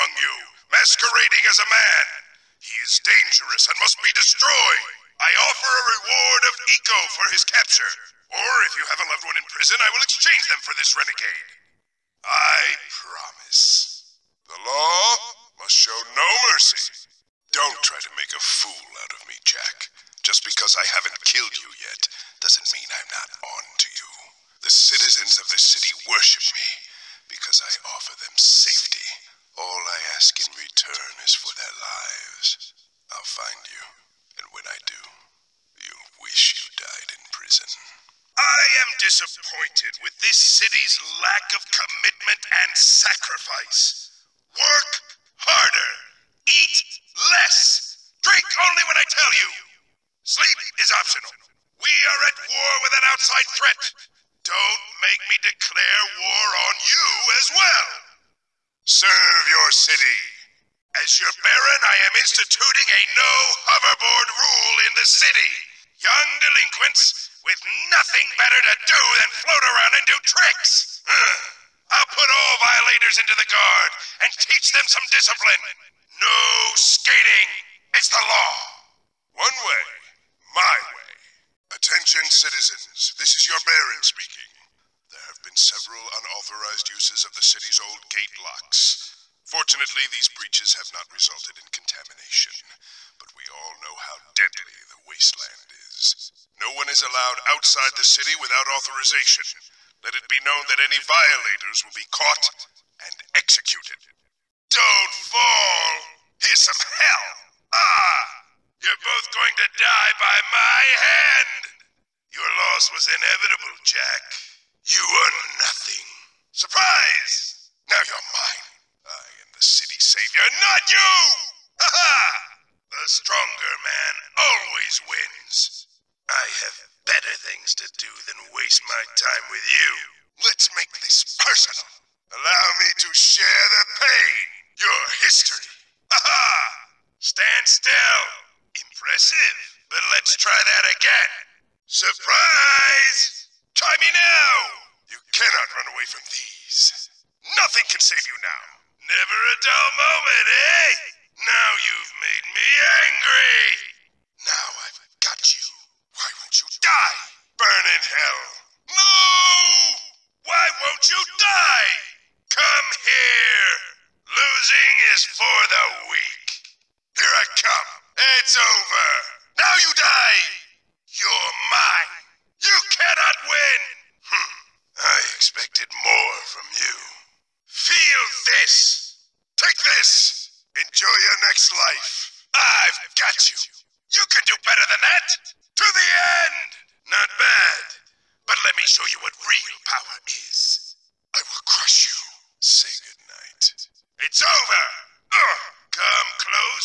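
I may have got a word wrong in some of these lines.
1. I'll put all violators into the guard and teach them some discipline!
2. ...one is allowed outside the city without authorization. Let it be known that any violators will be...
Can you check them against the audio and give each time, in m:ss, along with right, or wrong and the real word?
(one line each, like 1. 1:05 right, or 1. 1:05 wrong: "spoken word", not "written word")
1. 1:11 right
2. 1:36 right.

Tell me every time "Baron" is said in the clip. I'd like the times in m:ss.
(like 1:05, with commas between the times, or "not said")
1:01, 1:23.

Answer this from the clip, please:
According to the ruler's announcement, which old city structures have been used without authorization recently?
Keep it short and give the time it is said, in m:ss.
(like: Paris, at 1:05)
Gate locks, at 1:28.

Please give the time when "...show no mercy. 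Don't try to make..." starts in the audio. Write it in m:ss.
0:15.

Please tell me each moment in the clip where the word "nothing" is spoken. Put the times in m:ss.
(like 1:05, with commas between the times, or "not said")
1:07, 2:27.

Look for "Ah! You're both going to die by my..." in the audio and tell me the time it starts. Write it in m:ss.
1:47.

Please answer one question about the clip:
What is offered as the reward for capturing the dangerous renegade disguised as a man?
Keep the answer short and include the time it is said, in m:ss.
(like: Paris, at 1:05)
Eco, at 0:06.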